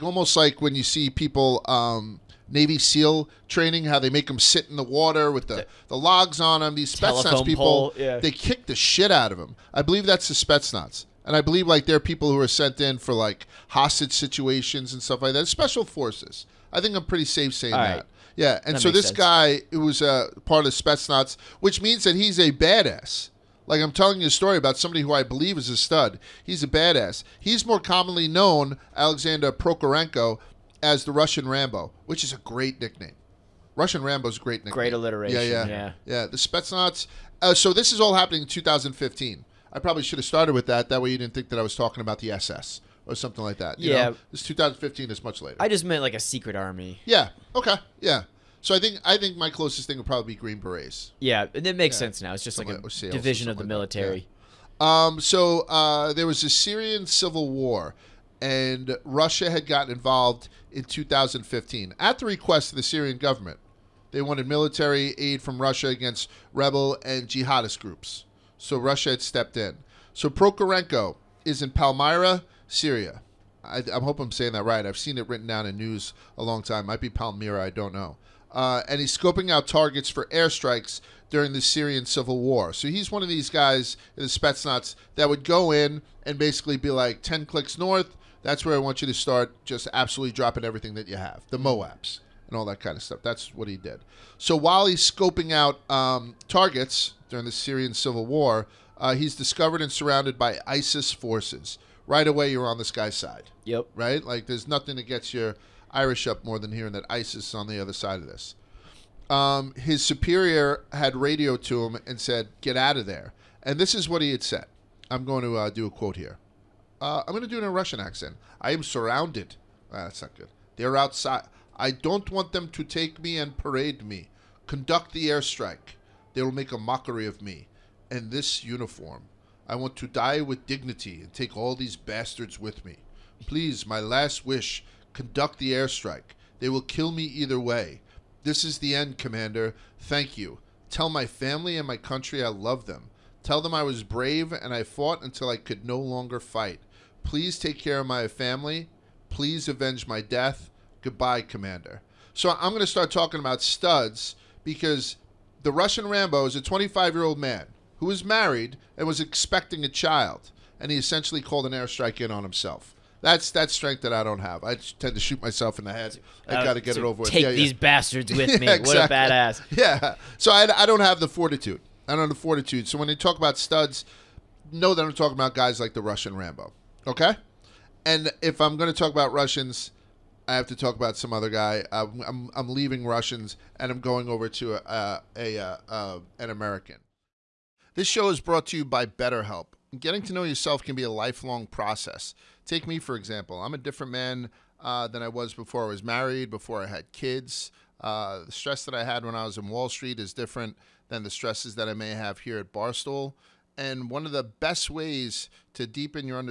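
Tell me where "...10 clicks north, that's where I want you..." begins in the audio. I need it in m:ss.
1:27.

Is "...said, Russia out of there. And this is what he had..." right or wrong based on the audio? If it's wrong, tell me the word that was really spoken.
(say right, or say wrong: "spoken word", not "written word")
wrong: "Get", not "Russia".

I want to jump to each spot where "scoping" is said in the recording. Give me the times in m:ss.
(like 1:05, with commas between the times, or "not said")
1:19, 1:35.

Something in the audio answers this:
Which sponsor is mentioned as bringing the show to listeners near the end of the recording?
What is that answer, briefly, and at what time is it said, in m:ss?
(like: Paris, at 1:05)
BetterHelp, at 3:09.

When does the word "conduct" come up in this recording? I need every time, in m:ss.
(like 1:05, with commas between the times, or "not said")
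2:04, 2:15.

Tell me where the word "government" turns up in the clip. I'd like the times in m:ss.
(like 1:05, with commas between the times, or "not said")
1:03.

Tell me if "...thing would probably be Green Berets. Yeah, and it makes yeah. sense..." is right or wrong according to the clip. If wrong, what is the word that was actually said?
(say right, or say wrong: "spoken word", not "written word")
right.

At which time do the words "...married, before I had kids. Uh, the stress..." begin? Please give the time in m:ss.
3:16.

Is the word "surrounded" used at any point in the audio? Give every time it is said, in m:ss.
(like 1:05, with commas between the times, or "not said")
1:39, 1:58.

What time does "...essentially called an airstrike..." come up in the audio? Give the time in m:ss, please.
2:40.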